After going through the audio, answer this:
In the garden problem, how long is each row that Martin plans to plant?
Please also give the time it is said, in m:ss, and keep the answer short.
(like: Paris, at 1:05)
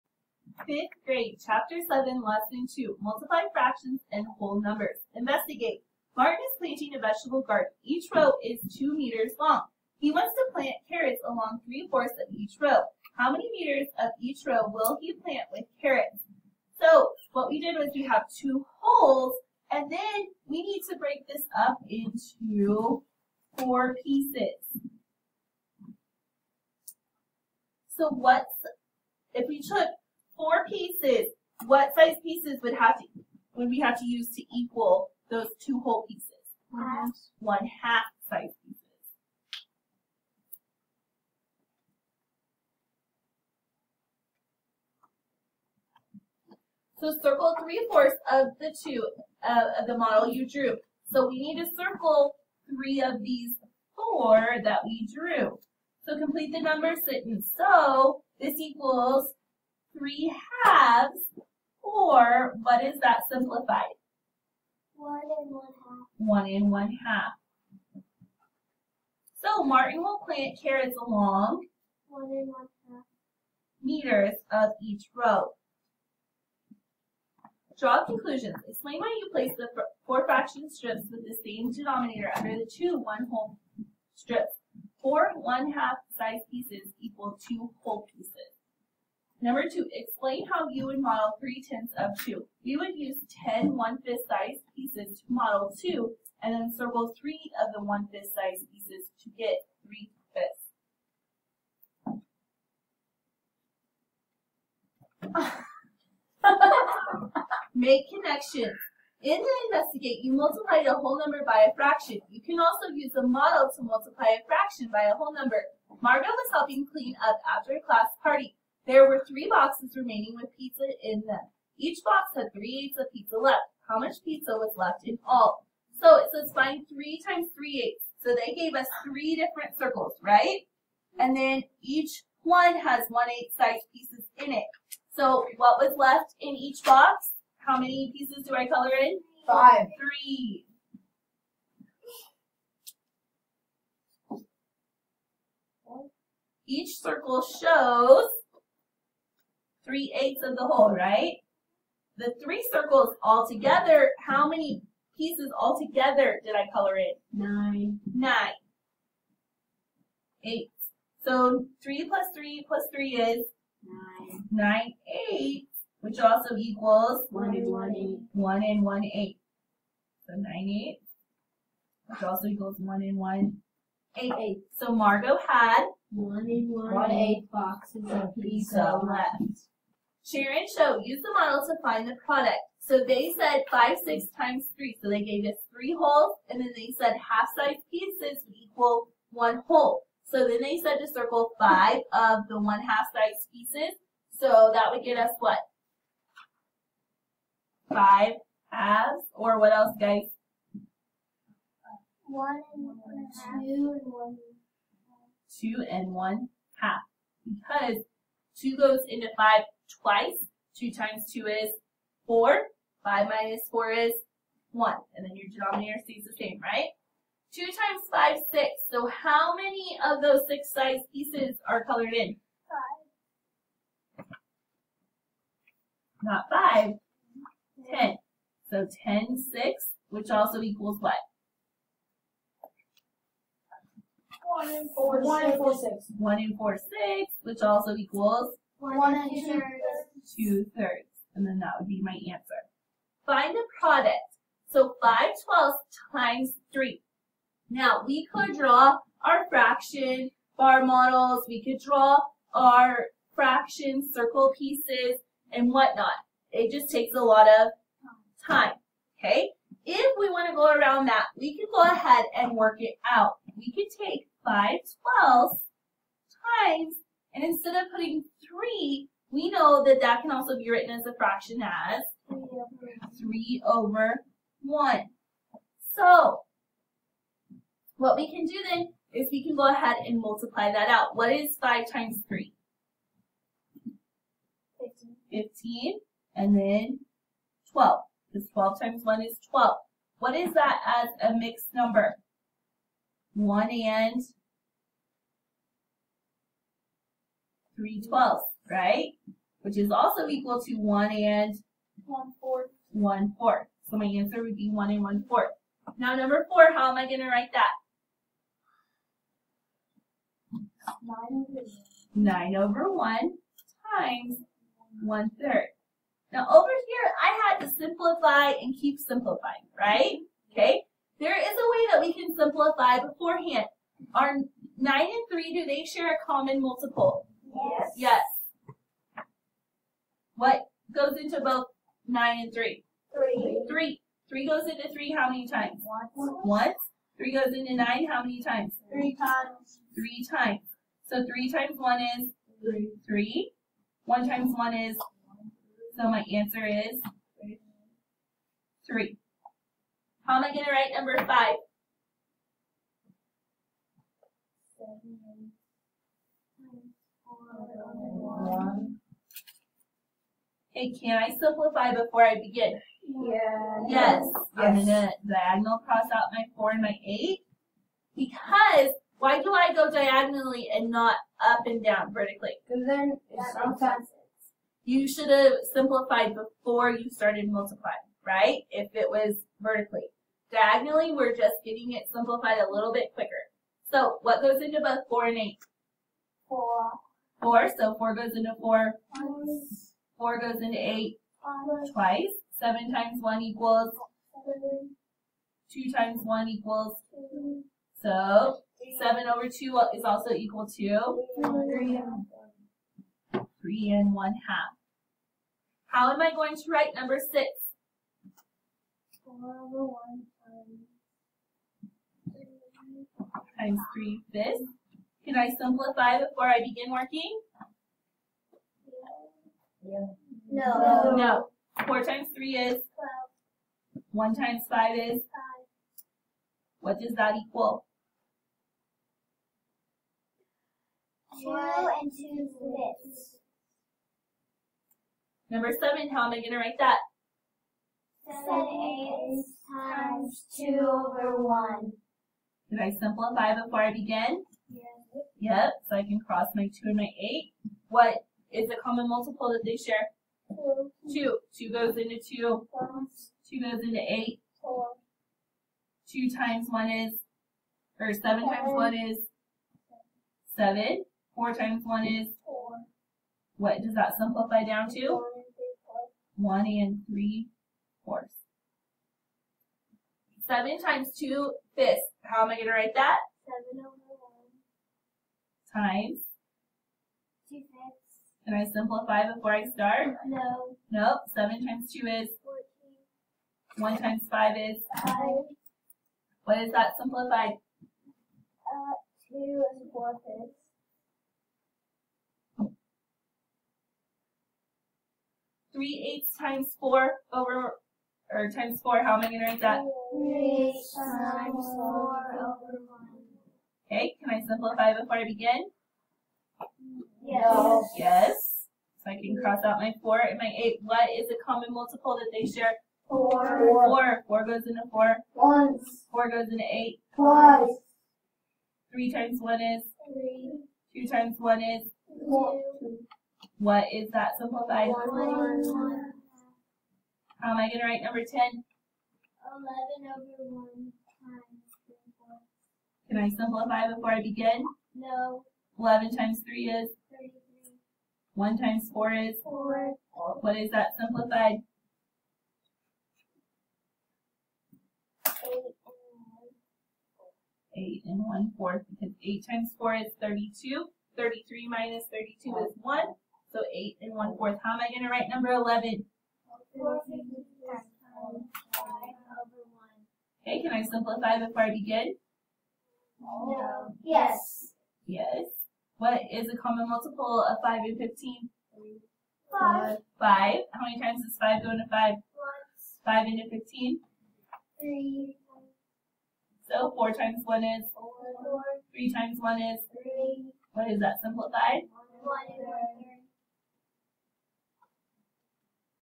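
2 meters, at 0:08.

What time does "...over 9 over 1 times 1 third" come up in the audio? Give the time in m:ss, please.
5:11.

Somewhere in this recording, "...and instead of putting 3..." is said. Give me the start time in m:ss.
4:27.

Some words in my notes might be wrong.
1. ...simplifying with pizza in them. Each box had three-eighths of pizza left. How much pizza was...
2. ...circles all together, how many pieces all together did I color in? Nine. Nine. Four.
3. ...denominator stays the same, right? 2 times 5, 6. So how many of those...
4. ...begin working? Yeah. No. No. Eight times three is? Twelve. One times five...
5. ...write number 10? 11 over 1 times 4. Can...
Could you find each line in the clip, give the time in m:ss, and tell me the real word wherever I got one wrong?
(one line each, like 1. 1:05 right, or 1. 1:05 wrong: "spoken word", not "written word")
1. 1:59 wrong: "remaining", not "simplifying"
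2. 2:32 wrong: "Eight", not "Four"
3. 3:35 right
4. 6:56 wrong: "Four", not "Eight"
5. 8:47 right.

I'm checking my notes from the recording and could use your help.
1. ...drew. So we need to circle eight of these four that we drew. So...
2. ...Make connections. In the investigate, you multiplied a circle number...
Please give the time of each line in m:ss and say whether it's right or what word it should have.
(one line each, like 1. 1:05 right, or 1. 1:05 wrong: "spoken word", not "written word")
1. 0:50 wrong: "three", not "eight"
2. 1:47 wrong: "whole", not "circle".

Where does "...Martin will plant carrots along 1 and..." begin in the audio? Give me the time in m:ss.
1:09.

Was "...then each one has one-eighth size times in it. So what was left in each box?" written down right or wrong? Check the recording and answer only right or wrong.
wrong.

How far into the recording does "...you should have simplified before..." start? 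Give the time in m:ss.
6:14.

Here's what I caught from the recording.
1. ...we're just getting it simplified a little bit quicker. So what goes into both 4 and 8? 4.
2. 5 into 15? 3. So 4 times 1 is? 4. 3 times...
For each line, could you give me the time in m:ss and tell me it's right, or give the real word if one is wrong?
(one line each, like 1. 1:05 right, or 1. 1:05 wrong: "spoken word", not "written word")
1. 6:21 right
2. 9:33 right.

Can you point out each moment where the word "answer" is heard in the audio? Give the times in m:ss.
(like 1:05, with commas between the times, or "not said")
4:02, 5:04, 5:46.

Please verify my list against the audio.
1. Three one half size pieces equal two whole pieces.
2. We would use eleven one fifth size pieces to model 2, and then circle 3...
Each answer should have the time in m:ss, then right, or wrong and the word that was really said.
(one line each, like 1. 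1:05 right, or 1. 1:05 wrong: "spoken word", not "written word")
1. 1:25 wrong: "Four", not "Three"
2. 1:32 wrong: "ten", not "eleven".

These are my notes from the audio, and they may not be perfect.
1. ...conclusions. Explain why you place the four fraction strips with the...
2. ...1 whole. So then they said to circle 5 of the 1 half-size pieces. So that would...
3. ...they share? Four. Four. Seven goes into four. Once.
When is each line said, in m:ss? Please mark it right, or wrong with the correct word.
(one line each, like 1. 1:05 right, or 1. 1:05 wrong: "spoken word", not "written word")
1. 1:18 right
2. 3:09 right
3. 8:32 wrong: "Four", not "Seven".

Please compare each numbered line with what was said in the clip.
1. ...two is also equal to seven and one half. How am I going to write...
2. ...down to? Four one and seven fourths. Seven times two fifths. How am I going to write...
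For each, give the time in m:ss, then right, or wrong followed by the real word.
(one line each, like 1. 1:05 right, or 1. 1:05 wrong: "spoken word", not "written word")
1. 6:39 wrong: "three", not "seven"
2. 7:44 wrong: "three", not "seven".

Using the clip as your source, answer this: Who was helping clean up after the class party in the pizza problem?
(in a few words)
Margo.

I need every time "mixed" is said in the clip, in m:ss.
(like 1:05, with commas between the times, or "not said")
4:51.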